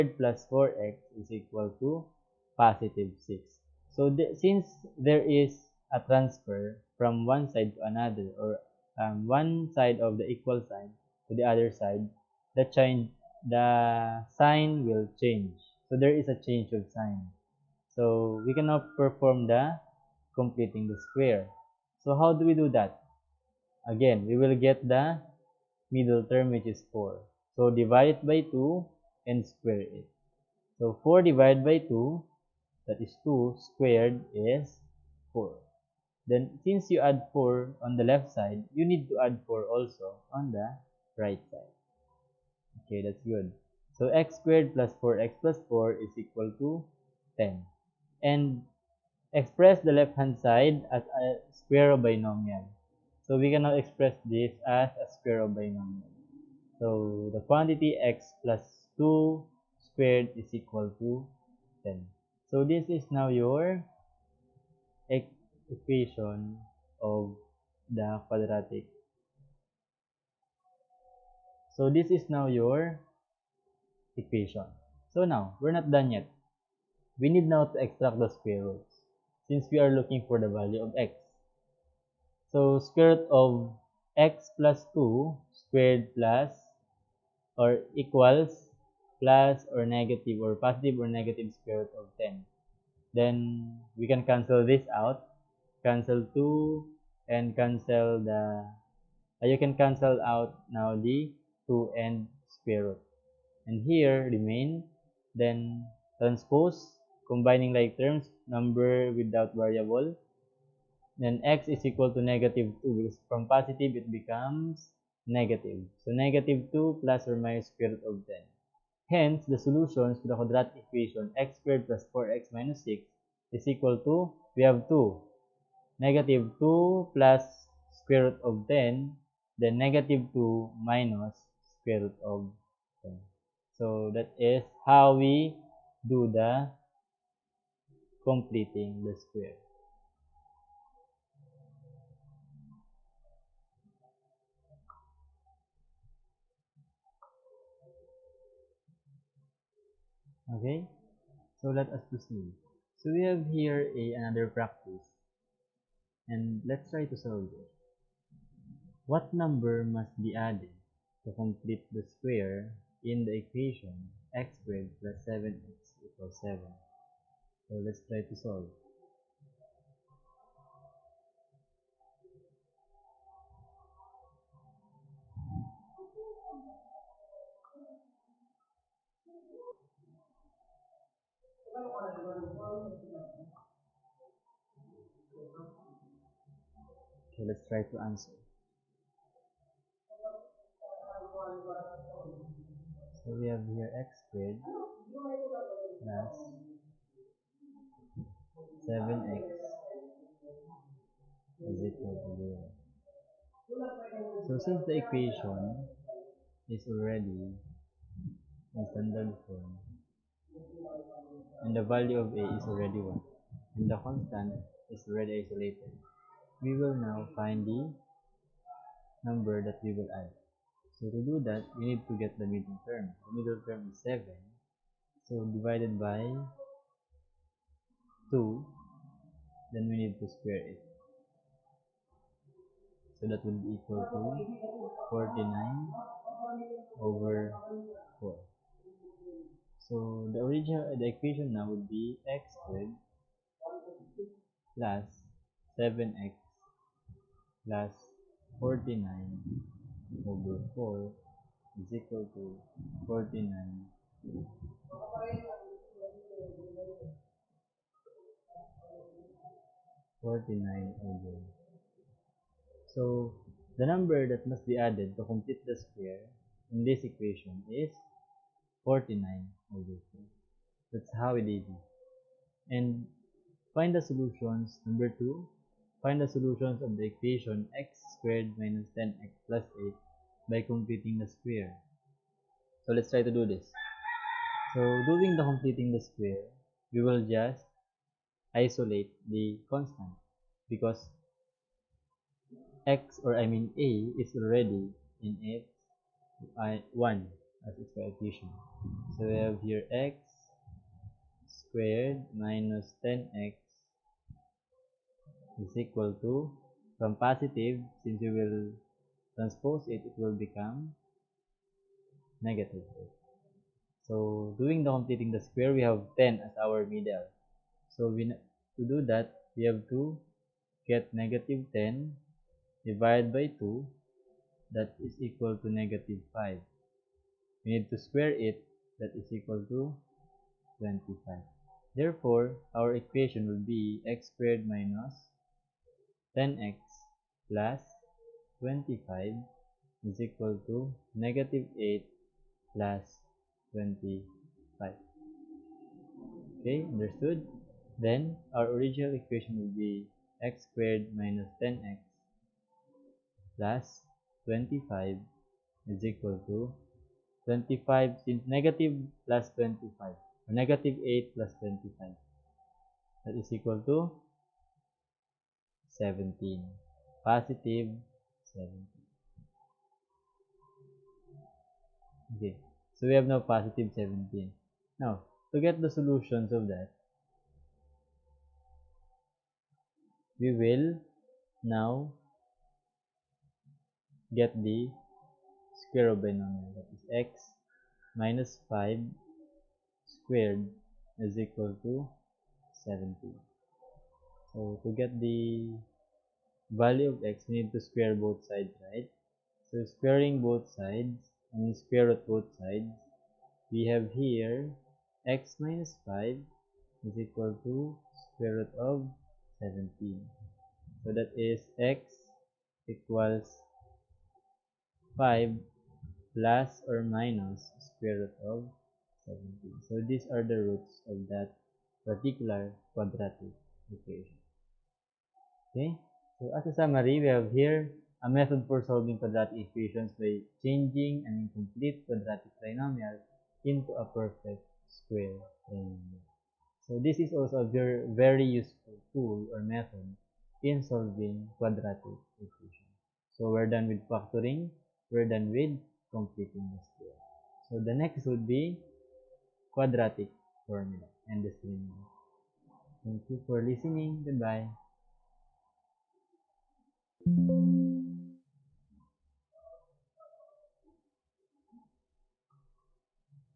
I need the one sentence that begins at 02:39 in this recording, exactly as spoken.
What number must be added to complete the square in the equation x squared plus 7x equals 7?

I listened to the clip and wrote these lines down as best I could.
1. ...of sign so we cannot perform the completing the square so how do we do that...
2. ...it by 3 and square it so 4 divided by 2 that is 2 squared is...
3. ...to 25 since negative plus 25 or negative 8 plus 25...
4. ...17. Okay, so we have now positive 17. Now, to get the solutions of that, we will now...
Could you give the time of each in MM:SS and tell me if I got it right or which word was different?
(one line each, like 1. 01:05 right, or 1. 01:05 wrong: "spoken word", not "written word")
1. 00:16 right
2. 00:28 wrong: "2", not "3"
3. 05:56 right
4. 06:08 right.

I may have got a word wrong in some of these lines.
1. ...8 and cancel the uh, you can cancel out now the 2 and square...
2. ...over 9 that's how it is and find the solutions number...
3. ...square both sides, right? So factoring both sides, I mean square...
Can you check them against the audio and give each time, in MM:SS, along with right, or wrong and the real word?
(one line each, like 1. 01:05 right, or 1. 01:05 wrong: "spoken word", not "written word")
1. 01:36 wrong: "2", not "8"
2. 04:29 wrong: "4", not "9"
3. 06:37 wrong: "squaring", not "factoring".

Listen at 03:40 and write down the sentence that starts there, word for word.
So to do that, we need to get the middle term.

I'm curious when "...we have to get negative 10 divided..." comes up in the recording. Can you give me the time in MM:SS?
05:19.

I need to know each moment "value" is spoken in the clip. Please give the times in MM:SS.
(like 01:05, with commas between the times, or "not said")
01:20, 03:31, 06:36.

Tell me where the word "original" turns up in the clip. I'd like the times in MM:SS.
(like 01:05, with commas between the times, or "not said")
04:00, 05:48.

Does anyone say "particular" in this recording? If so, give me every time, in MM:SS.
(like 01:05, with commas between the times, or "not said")
07:02.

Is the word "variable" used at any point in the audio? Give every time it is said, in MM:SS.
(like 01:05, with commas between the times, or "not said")
01:49.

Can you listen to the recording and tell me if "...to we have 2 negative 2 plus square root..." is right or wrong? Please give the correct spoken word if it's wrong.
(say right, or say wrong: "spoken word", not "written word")
right.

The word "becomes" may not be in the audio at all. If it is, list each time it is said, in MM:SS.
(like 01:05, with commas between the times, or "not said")
01:54, 05:10.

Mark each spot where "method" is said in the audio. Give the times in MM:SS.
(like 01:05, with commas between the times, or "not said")
07:08, 07:19.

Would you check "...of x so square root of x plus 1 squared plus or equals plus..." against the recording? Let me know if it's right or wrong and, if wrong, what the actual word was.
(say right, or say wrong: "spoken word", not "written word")
wrong: "2", not "1".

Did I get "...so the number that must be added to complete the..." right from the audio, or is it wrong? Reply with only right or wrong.
right.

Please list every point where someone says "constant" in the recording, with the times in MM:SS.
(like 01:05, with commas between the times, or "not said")
03:33, 04:49.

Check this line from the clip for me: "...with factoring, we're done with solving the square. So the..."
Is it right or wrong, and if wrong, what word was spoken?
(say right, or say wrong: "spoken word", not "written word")
wrong: "completing", not "solving".